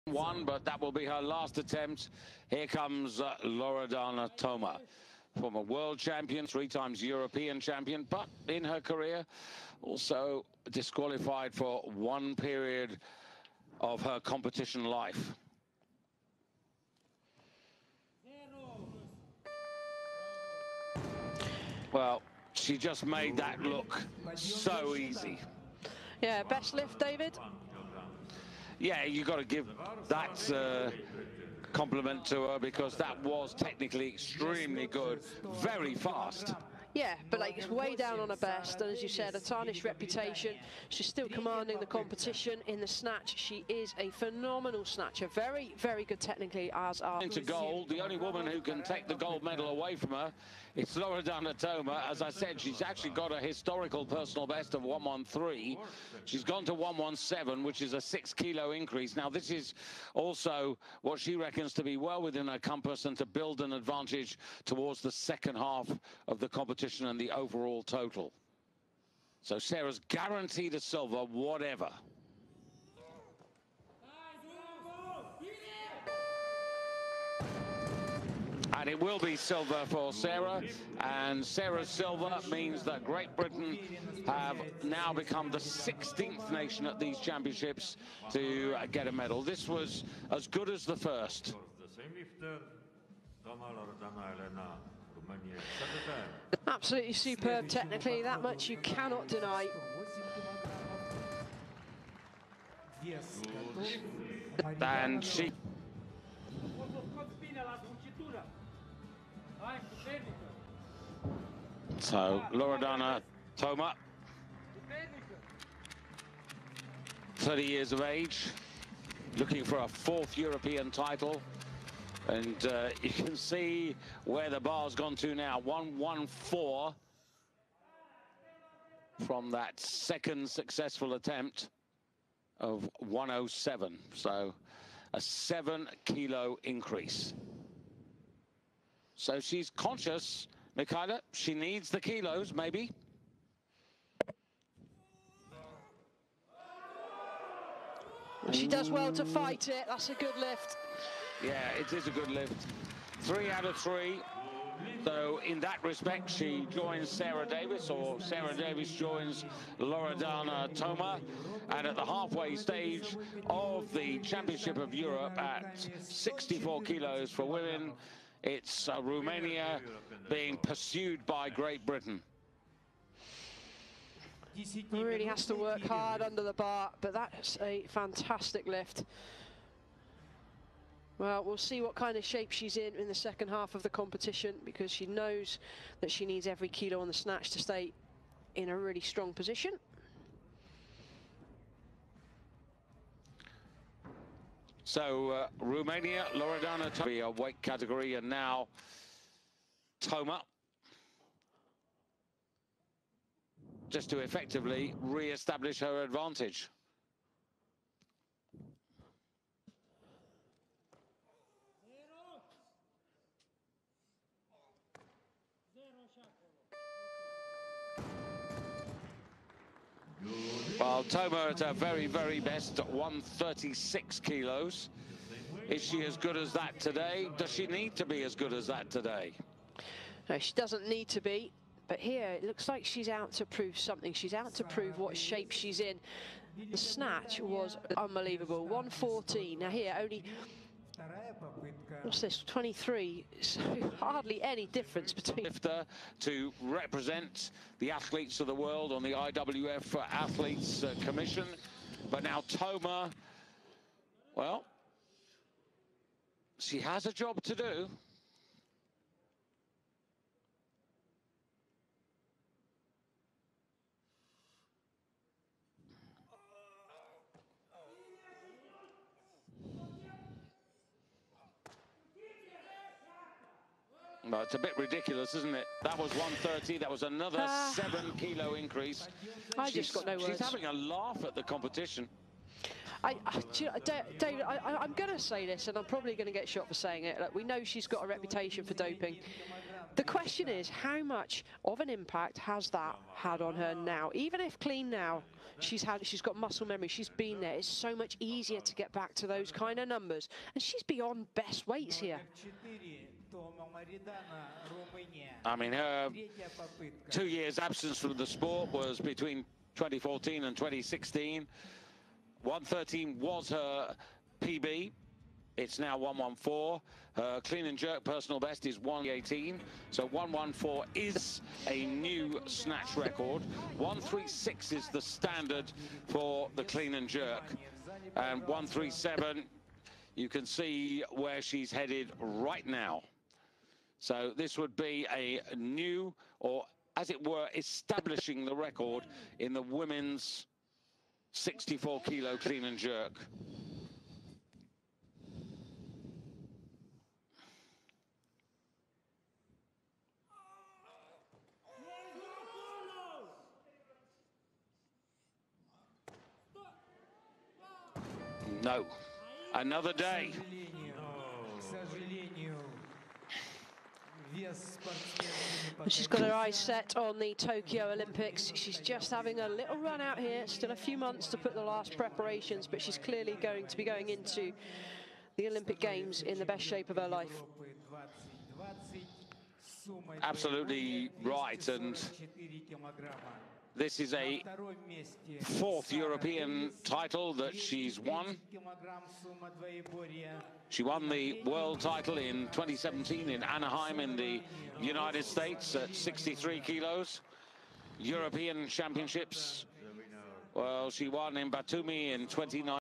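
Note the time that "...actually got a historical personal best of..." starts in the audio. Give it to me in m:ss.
0:52.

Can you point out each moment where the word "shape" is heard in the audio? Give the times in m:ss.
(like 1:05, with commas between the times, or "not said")
3:02, 3:55, 6:16.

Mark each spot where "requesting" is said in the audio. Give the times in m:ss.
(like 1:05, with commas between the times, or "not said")
not said.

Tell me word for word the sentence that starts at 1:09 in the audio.
So Sarah's guaranteed a silver, whatever.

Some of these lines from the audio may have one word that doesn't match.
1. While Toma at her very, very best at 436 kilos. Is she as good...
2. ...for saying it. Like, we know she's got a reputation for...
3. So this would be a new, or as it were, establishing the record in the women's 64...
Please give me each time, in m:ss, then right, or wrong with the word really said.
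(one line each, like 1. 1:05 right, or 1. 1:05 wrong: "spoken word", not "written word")
1. 3:40 wrong: "136", not "436"
2. 4:46 right
3. 5:33 right.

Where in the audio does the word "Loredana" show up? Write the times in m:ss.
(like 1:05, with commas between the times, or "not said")
0:03, 0:50, 1:52, 2:39, 3:16.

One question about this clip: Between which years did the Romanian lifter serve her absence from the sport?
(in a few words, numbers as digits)
2014 and 2016.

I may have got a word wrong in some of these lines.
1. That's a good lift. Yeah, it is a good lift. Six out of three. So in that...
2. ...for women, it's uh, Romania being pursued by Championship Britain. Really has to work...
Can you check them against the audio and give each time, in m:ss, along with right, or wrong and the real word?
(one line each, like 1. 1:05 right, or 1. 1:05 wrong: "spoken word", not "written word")
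1. 2:29 wrong: "Three", not "Six"
2. 2:47 wrong: "Great", not "Championship".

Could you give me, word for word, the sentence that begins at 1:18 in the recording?
And it will be silver for Sarah.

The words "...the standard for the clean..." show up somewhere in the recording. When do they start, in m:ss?
5:24.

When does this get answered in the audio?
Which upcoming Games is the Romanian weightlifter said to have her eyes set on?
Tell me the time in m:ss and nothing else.
6:07.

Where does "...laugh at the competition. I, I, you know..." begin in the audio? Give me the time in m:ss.
4:40.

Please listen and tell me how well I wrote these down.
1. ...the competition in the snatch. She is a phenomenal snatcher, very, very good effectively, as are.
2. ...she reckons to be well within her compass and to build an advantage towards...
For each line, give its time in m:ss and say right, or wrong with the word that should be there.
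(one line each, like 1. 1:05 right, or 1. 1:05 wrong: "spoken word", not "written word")
1. 0:41 wrong: "technically", not "effectively"
2. 1:01 right.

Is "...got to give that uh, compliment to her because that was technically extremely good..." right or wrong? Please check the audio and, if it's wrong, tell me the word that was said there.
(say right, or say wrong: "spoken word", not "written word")
right.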